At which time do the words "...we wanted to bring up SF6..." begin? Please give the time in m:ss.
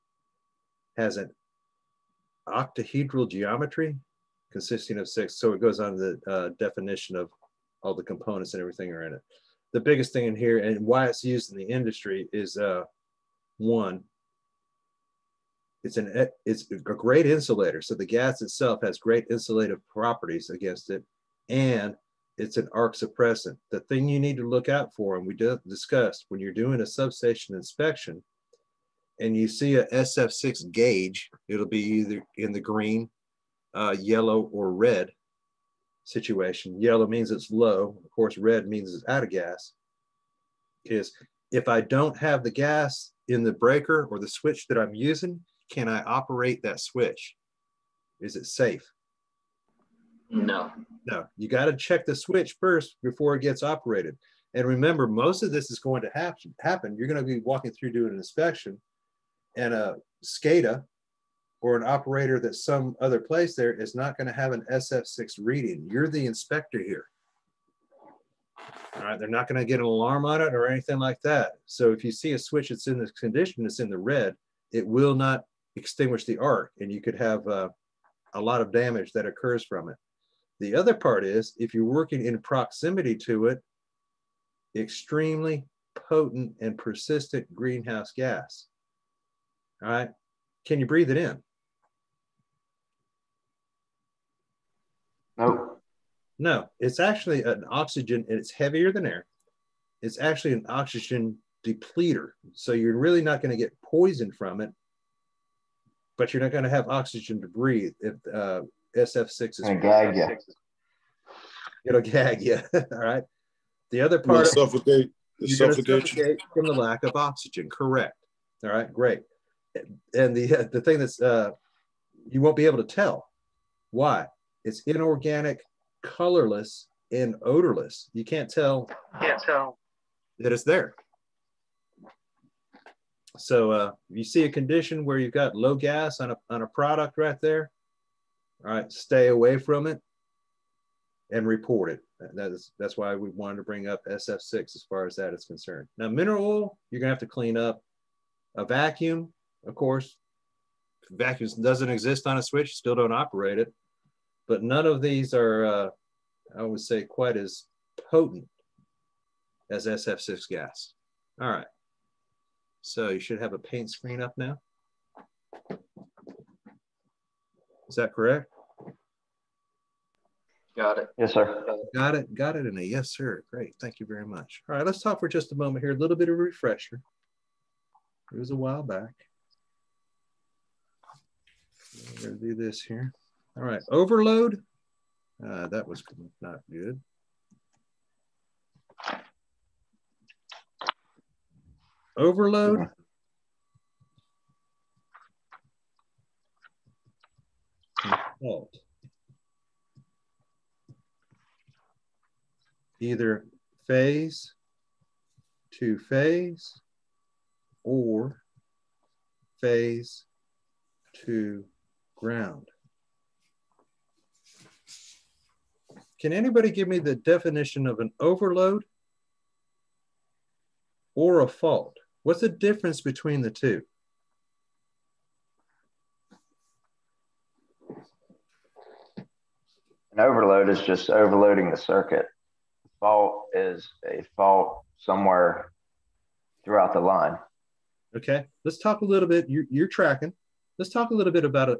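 2:23.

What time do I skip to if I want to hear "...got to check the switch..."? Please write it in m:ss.
0:51.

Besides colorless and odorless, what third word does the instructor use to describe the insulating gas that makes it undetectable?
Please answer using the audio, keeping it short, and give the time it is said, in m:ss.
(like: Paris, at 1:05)
Inorganic, at 2:04.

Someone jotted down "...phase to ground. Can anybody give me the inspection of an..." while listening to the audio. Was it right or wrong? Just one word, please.
wrong.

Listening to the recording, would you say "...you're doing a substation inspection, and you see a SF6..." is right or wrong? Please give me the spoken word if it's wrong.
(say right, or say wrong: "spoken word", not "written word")
right.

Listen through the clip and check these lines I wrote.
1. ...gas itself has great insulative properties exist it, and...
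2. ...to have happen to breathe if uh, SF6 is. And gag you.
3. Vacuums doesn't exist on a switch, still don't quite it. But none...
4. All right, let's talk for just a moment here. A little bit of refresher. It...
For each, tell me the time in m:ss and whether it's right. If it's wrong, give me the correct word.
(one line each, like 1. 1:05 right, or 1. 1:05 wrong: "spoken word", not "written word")
1. 0:18 wrong: "against", not "exist"
2. 1:46 wrong: "oxygen", not "happen"
3. 2:31 wrong: "operate", not "quite"
4. 2:54 right.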